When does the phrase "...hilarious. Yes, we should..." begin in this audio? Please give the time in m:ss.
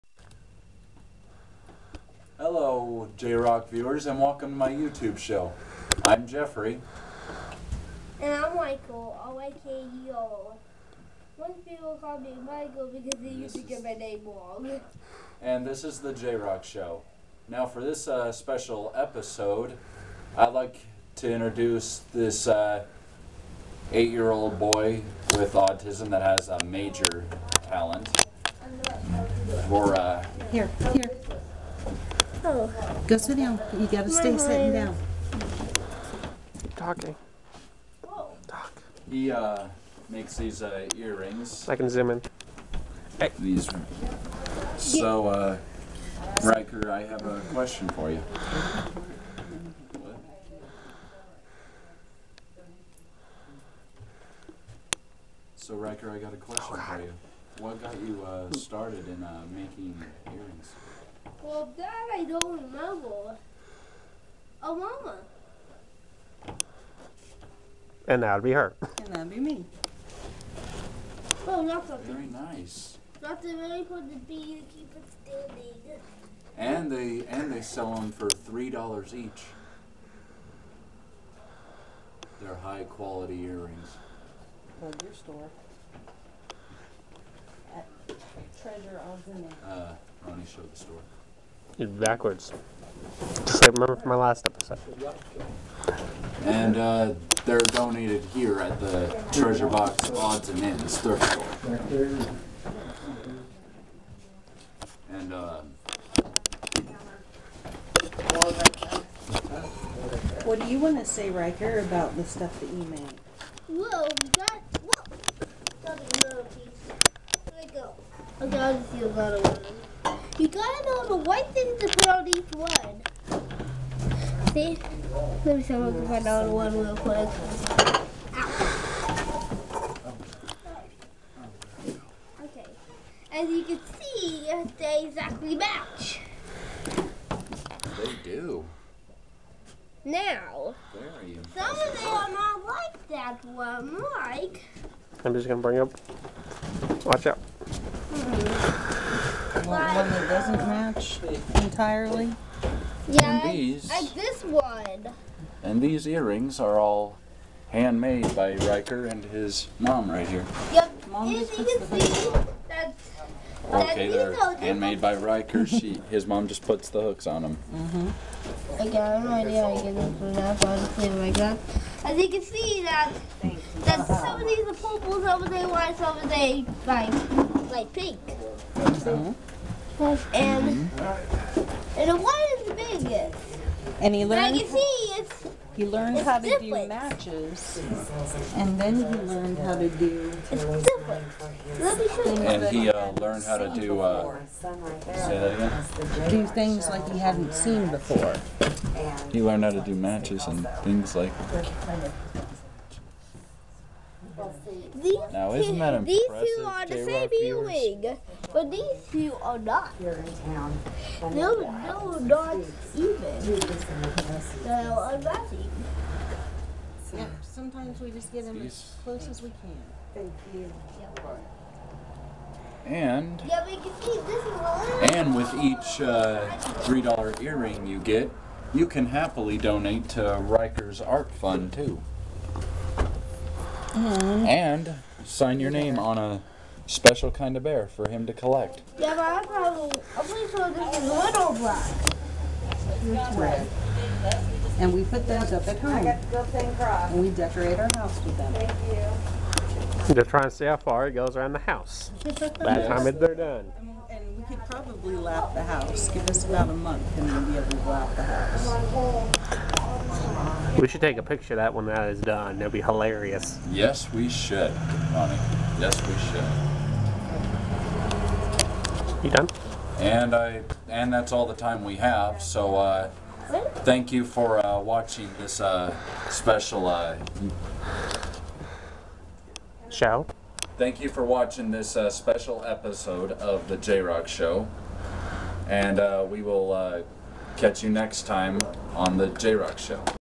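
4:22.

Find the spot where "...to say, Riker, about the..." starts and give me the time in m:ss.
1:50.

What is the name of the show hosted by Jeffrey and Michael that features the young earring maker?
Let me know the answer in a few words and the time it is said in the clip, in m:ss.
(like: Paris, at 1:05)
J-Rock Show, at 0:15.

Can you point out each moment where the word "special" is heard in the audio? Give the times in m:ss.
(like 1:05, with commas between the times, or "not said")
0:18, 3:56, 4:36, 4:42.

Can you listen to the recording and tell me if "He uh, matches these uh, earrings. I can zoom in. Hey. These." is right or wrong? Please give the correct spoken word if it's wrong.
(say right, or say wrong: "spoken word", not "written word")
wrong: "makes", not "matches".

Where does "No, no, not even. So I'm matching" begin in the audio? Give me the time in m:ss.
3:31.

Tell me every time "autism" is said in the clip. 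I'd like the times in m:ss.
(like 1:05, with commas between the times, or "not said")
0:25.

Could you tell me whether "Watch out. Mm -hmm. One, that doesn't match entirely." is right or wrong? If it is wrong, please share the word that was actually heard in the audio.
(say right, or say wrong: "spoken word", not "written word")
right.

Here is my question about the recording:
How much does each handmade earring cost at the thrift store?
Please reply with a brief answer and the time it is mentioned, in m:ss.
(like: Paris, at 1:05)
$3, at 1:18.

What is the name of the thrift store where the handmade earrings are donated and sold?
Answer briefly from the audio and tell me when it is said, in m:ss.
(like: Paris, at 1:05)
Treasure Box Odds and Ends, at 1:39.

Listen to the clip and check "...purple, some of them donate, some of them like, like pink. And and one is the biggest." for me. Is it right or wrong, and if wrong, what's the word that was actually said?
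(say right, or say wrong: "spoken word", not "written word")
wrong: "white", not "donate".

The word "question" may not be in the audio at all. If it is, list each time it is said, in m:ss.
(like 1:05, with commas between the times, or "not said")
0:47, 0:56.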